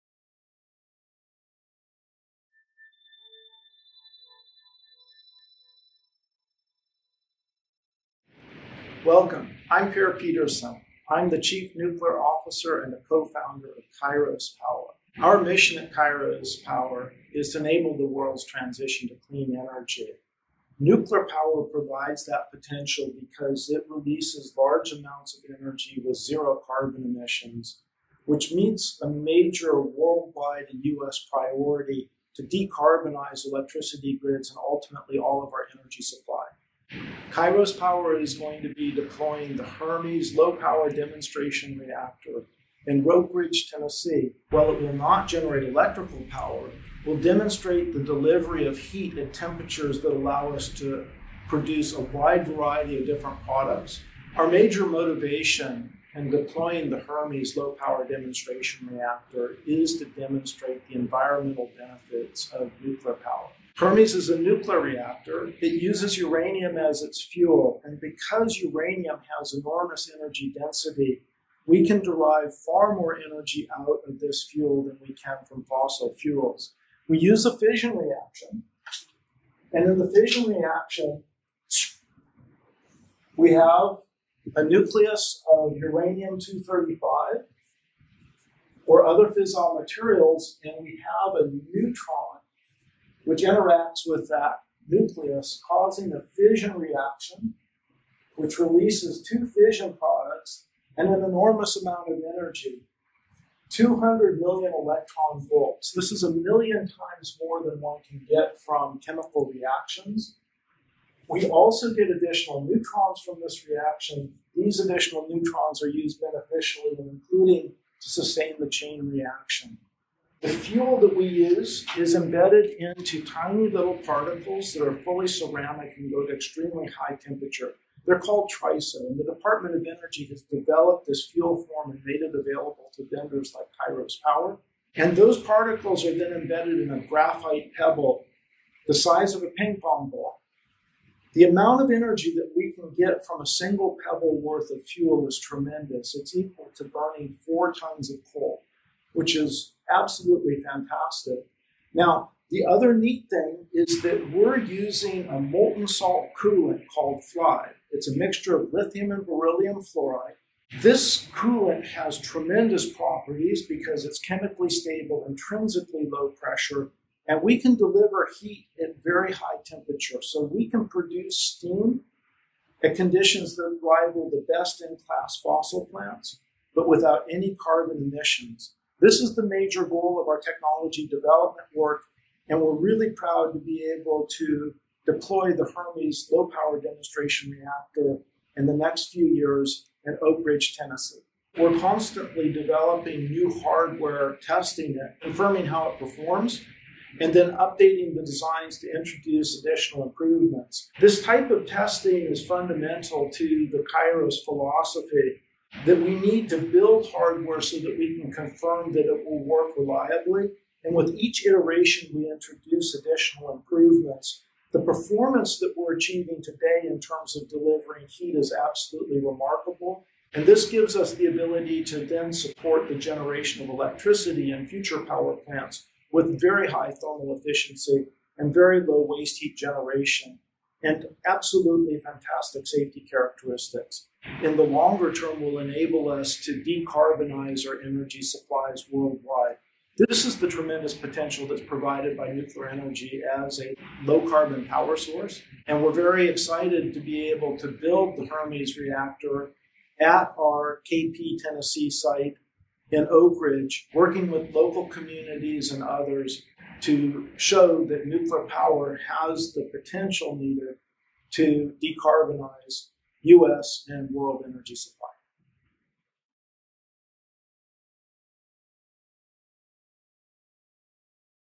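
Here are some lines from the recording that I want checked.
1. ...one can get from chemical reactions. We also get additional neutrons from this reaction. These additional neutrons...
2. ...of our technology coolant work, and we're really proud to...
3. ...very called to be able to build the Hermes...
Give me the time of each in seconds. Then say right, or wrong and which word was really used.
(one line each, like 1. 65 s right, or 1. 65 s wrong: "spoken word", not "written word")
1. 107 s right
2. 180 s wrong: "development", not "coolant"
3. 245 s wrong: "excited", not "called".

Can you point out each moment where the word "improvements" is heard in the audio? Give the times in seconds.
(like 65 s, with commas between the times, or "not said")
200 s, 213 s.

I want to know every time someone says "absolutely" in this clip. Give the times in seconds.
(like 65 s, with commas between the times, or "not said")
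149 s, 218 s, 231 s.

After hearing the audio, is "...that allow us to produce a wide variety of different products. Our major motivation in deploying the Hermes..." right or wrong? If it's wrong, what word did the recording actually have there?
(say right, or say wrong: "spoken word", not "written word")
right.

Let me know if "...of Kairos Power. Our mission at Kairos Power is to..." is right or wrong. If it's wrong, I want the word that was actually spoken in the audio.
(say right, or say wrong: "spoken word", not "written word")
right.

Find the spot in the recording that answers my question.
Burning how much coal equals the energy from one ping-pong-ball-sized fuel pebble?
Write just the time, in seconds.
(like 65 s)
147 s.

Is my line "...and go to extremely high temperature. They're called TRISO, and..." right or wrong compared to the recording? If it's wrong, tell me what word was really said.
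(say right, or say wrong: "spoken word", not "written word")
right.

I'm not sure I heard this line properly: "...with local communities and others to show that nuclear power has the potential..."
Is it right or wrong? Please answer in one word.
right.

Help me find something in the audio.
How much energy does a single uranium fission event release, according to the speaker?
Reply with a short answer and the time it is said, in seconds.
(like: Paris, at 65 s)
200 million electron volts, at 103 s.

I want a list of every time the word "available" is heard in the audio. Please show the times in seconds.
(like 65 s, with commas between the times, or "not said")
132 s.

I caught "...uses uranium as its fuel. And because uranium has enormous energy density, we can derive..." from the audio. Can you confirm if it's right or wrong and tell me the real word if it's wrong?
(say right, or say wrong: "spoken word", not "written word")
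right.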